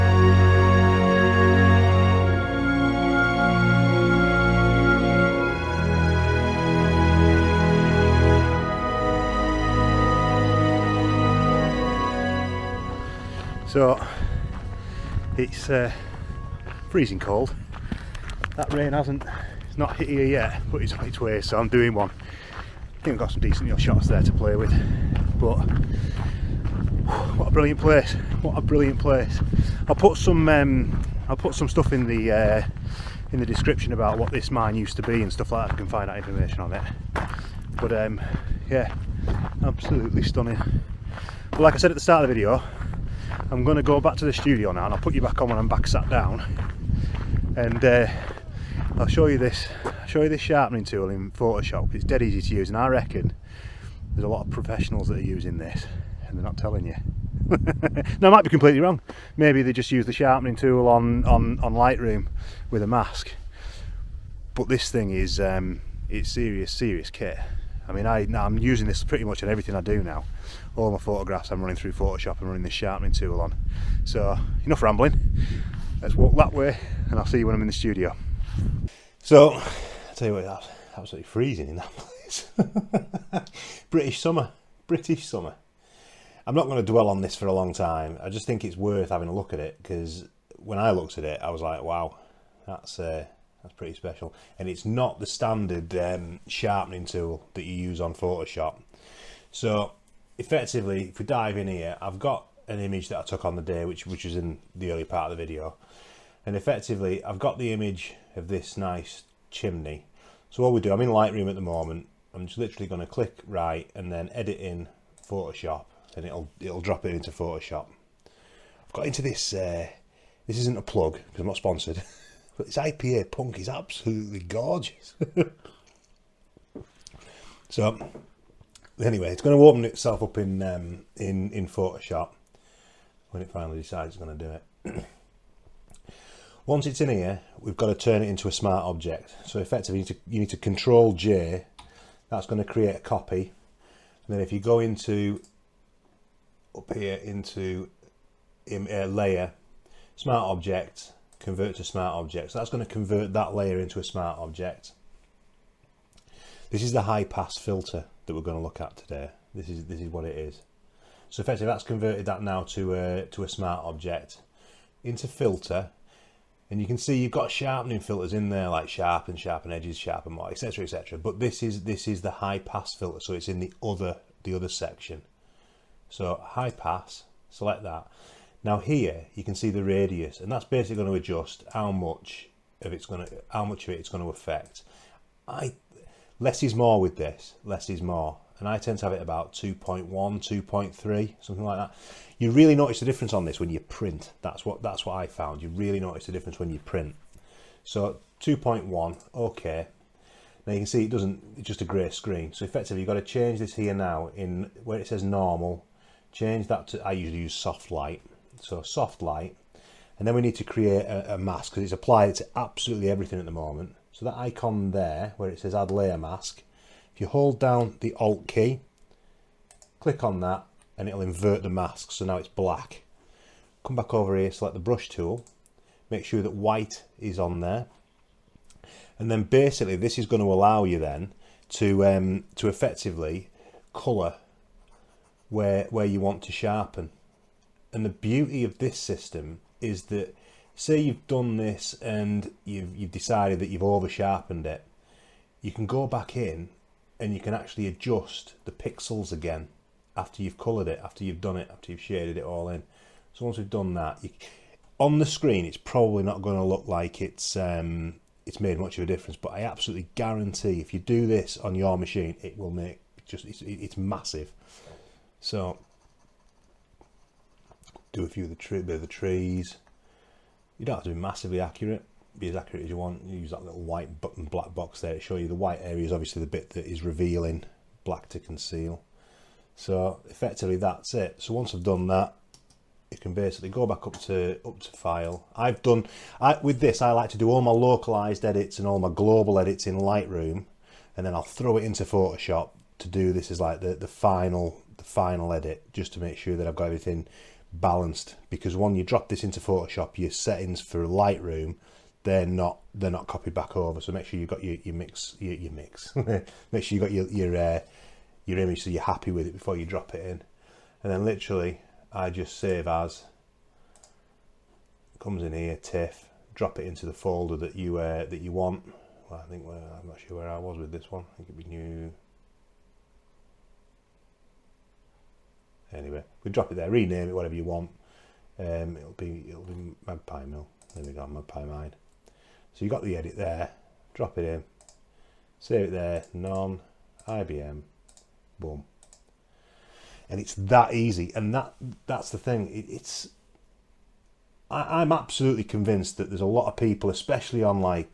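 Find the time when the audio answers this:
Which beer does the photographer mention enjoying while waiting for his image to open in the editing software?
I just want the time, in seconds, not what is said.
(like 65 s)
122 s.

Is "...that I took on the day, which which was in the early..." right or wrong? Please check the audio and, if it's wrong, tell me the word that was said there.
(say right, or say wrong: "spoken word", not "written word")
right.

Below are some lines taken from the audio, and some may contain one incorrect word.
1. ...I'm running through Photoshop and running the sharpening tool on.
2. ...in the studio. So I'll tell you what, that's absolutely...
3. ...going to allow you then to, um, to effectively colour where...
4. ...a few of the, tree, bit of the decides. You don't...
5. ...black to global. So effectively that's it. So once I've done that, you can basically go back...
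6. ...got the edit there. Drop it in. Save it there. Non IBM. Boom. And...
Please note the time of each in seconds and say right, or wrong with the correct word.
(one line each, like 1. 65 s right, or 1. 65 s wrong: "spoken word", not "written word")
1. 71 s right
2. 77 s right
3. 230 s right
4. 268 s wrong: "trees", not "decides"
5. 278 s wrong: "conceal", not "global"
6. 332 s right.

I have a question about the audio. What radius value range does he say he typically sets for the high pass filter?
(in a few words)
2.1 to 2.3.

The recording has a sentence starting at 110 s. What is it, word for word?
So what we do, I'm in Lightroom at the moment.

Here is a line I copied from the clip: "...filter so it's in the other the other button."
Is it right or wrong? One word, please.
wrong.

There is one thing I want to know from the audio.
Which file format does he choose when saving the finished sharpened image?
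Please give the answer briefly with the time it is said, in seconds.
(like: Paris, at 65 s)
TIFF, at 315 s.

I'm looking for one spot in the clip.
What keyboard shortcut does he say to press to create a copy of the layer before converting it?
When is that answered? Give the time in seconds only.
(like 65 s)
140 s.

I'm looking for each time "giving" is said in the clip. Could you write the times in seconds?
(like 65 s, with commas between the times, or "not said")
not said.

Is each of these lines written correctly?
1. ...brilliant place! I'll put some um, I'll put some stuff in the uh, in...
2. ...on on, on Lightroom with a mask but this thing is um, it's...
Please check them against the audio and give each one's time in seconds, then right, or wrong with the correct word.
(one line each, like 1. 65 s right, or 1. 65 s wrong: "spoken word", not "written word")
1. 28 s right
2. 60 s right.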